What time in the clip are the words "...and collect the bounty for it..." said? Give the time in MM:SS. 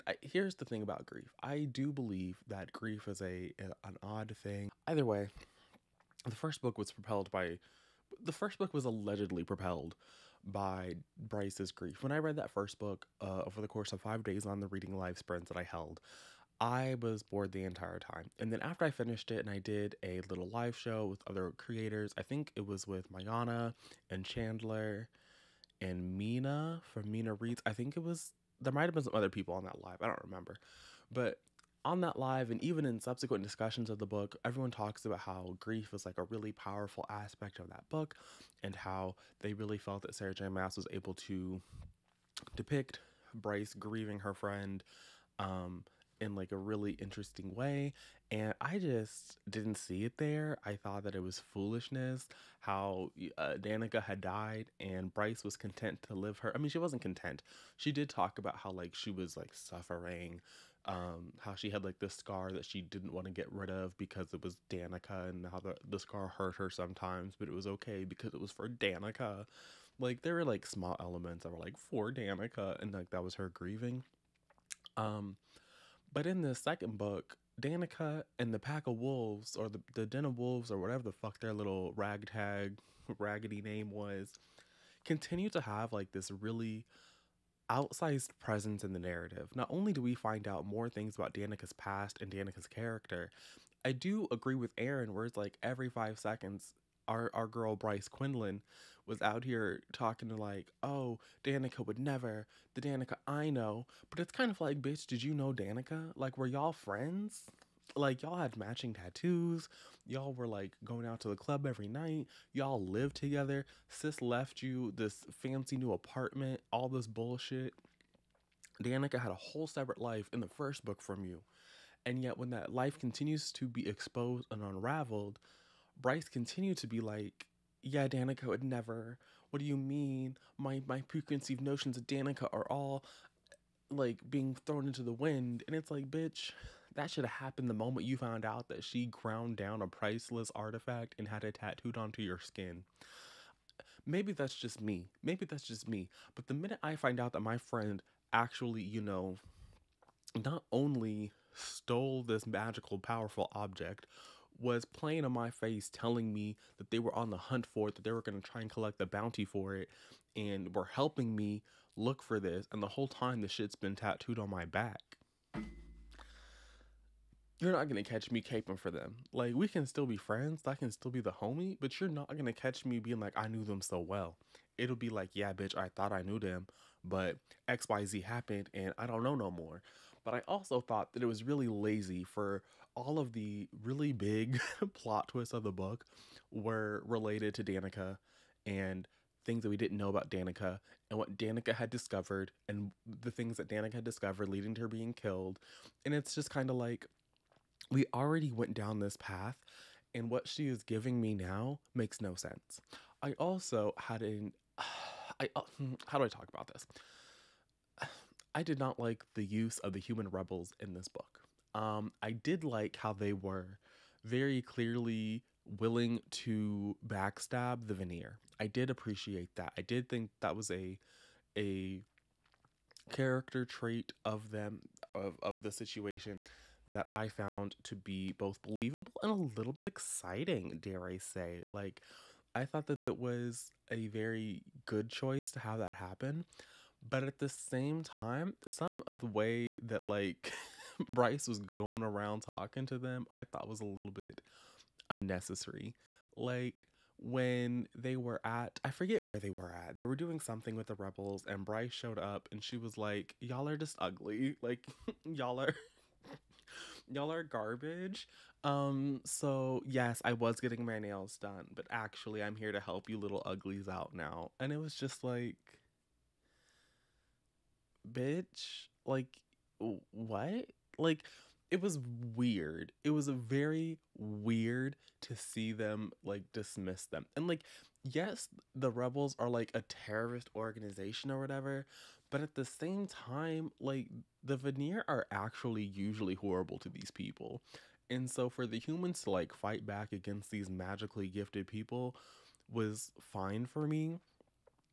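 02:38.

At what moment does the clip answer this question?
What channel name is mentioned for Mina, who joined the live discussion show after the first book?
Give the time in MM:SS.
00:26.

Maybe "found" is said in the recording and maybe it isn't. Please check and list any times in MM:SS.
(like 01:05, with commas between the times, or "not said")
02:18, 03:47.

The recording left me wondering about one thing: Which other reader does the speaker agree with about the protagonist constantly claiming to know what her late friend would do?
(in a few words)
Aaron.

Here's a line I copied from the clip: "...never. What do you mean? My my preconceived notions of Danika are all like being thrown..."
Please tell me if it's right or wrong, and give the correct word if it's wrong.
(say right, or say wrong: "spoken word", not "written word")
right.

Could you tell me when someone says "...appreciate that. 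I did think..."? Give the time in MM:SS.
03:38.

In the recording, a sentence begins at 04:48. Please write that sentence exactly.
And so for the humans to like fight back against these magically gifted people was fine for me.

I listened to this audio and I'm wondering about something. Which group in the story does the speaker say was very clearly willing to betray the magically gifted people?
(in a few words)
The human rebels.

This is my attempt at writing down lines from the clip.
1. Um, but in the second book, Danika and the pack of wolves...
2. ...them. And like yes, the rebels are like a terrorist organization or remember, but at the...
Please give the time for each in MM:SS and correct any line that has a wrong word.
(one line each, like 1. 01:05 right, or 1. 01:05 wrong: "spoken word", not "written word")
1. 01:14 right
2. 04:37 wrong: "whatever", not "remember".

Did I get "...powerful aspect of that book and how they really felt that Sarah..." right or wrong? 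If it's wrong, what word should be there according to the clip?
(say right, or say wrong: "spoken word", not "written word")
right.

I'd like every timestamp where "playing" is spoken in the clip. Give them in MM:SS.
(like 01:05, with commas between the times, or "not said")
02:34.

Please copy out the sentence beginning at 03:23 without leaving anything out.
I also had an I uh, hmm, how do I talk about this?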